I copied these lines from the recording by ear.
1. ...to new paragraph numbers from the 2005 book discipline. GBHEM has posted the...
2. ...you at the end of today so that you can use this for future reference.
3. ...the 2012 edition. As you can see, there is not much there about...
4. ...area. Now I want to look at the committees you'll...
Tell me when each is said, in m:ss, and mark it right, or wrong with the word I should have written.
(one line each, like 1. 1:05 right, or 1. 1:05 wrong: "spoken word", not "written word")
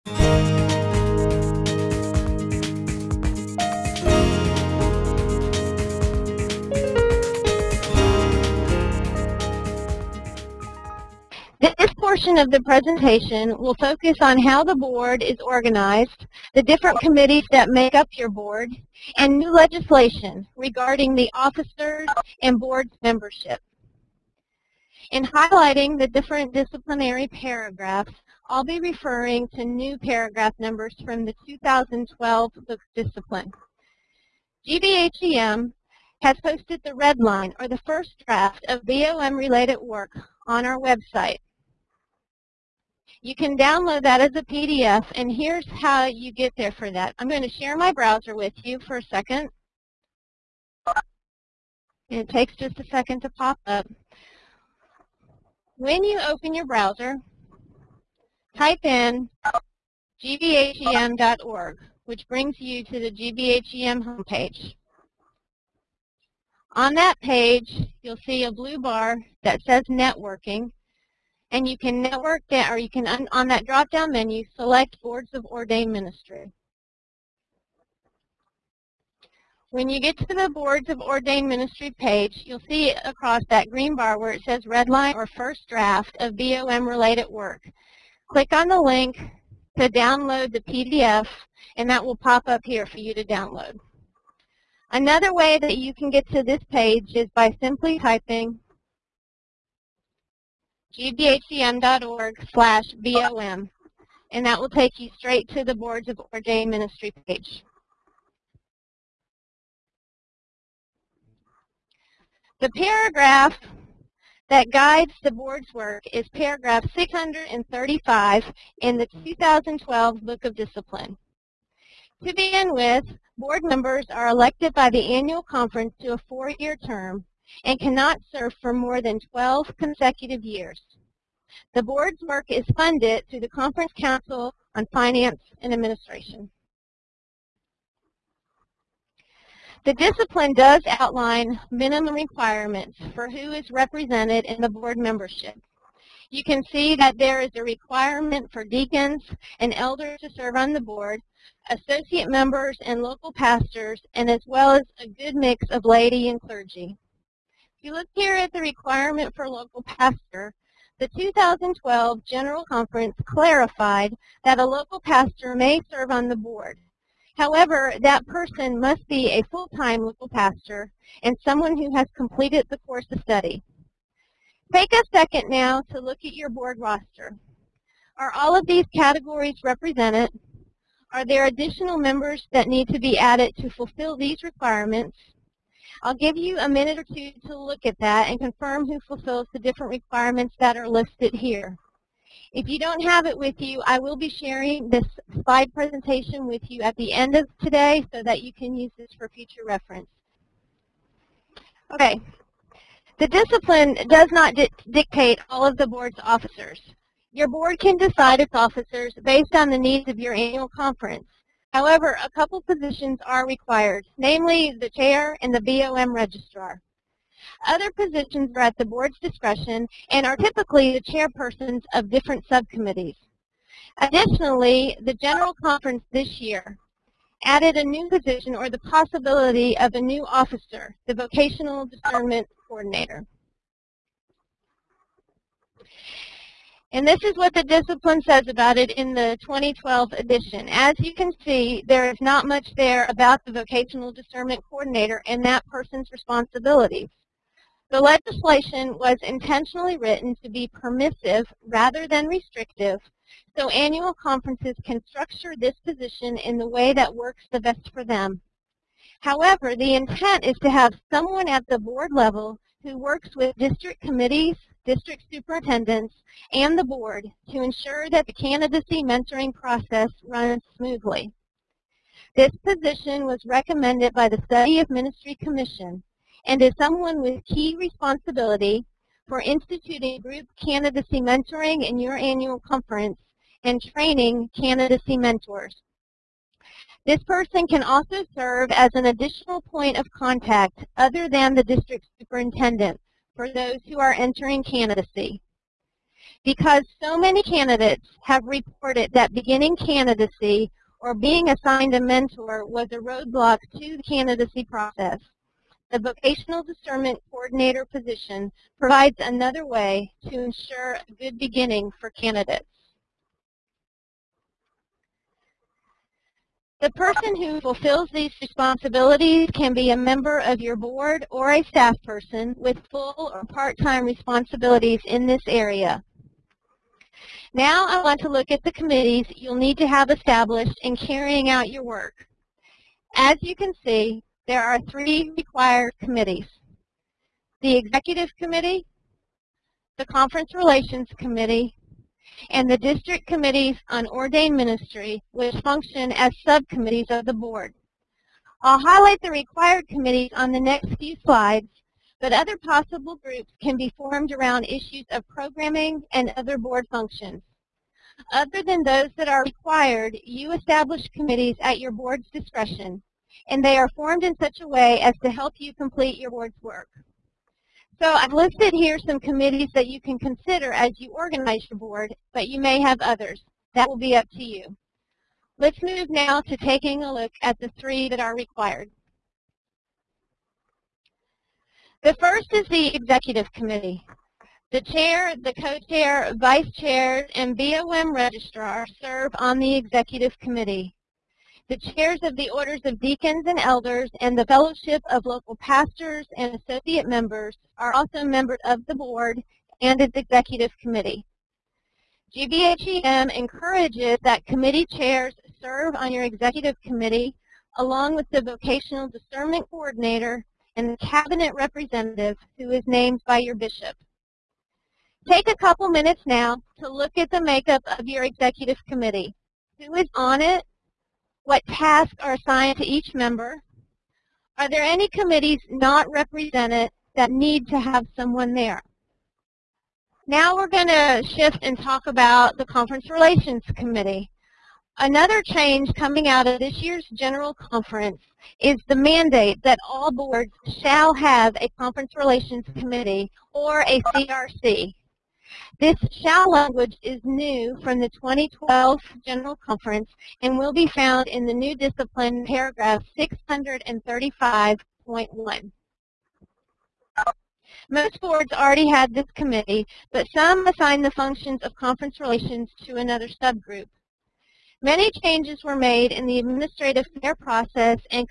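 1. 0:29 wrong: "2012", not "2005"
2. 3:16 right
3. 3:59 right
4. 5:25 right.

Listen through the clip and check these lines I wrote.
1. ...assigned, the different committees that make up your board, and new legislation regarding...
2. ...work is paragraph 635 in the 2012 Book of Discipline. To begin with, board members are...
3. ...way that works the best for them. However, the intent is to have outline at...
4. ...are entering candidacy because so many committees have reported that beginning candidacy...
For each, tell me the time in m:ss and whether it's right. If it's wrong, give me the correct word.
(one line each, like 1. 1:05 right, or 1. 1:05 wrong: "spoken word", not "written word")
1. 0:15 wrong: "organized", not "assigned"
2. 1:55 right
3. 4:16 wrong: "someone", not "outline"
4. 4:53 wrong: "candidates", not "committees".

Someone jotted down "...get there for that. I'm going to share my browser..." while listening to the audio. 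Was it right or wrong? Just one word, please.
right.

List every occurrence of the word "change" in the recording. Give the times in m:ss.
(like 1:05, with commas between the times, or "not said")
7:15, 7:45.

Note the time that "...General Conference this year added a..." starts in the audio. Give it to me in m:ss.
3:45.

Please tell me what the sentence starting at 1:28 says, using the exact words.
Click on the link to download the PDF, and that will pop up here for you to download.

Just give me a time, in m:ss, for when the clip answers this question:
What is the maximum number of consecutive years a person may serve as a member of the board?
2:09.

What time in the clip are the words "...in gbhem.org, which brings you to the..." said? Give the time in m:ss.
0:58.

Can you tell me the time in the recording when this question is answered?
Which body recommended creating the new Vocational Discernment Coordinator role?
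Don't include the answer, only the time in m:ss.
4:34.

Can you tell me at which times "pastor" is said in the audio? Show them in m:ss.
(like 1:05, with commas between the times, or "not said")
2:33, 2:39, 2:44, 2:50, 6:35.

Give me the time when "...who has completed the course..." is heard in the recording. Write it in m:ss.
2:51.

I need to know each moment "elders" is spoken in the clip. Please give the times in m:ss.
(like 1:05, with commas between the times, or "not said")
2:29, 6:33.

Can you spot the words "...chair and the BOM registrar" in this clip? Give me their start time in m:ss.
3:34.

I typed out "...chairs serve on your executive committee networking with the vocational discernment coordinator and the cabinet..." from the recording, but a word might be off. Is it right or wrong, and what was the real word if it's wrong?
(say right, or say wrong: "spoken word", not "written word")
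wrong: "along", not "networking".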